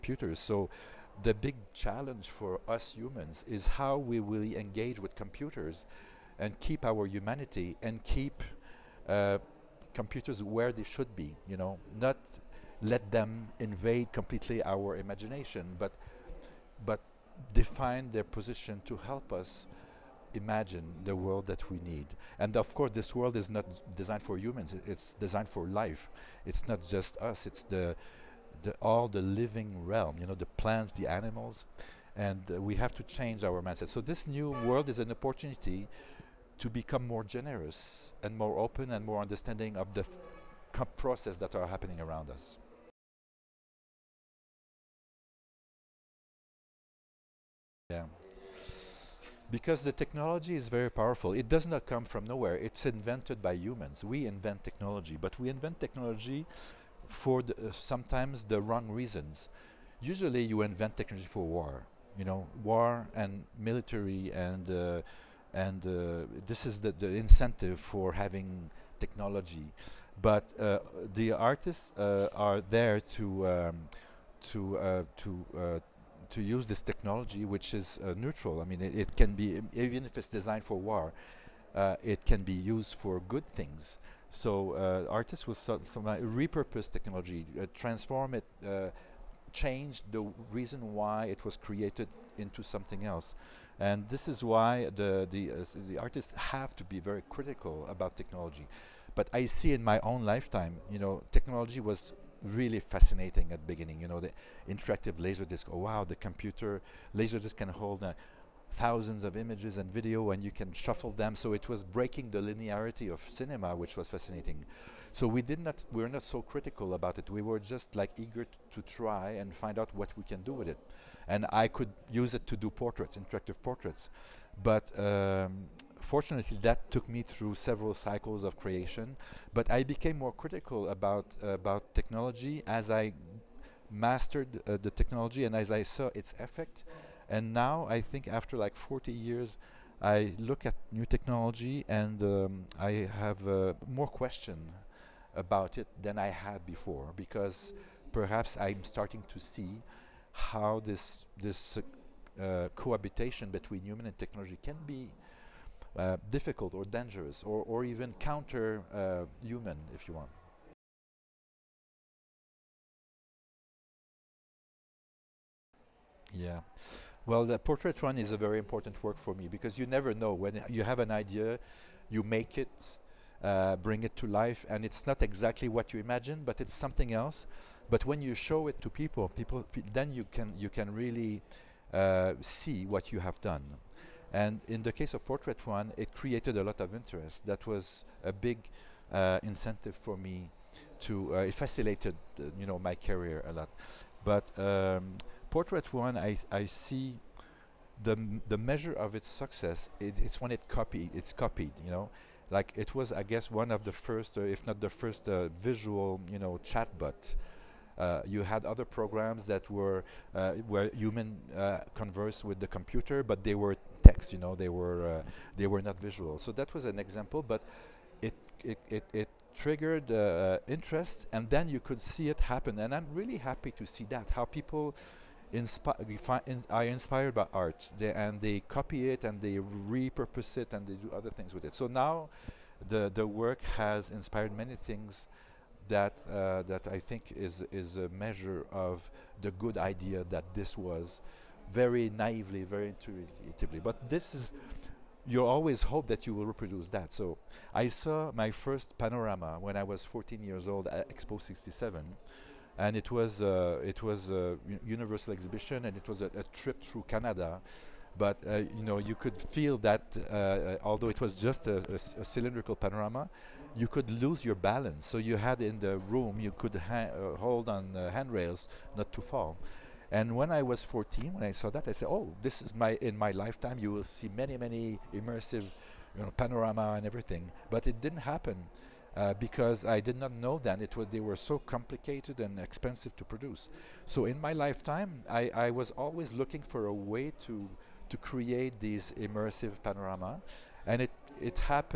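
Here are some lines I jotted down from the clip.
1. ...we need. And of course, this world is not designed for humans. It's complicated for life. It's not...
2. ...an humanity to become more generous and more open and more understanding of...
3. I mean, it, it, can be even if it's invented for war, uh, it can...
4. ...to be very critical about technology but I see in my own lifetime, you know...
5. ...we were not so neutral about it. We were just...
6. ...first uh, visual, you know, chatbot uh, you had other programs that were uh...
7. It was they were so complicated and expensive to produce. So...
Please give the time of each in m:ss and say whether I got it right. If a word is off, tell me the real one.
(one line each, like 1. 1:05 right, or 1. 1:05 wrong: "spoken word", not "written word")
1. 0:21 wrong: "designed", not "complicated"
2. 0:34 wrong: "opportunity", not "humanity"
3. 1:18 wrong: "designed", not "invented"
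4. 1:36 right
5. 1:55 wrong: "critical", not "neutral"
6. 3:24 right
7. 4:40 right.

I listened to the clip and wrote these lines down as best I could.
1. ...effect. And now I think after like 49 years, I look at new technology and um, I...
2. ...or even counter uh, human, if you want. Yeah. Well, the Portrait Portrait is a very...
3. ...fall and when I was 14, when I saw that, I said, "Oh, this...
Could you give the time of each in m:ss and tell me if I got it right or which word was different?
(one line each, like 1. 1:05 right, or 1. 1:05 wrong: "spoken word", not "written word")
1. 2:16 wrong: "40", not "49"
2. 2:37 wrong: "One", not "Portrait"
3. 4:29 right.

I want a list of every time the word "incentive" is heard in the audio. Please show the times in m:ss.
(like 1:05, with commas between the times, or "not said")
1:07, 3:09.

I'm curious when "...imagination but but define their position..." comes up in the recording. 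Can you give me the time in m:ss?
0:14.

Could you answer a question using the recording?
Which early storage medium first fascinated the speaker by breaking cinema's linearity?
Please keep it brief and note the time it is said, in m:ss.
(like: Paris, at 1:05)
Interactive laser disc, at 1:44.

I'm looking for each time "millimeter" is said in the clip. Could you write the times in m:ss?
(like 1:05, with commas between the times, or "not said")
not said.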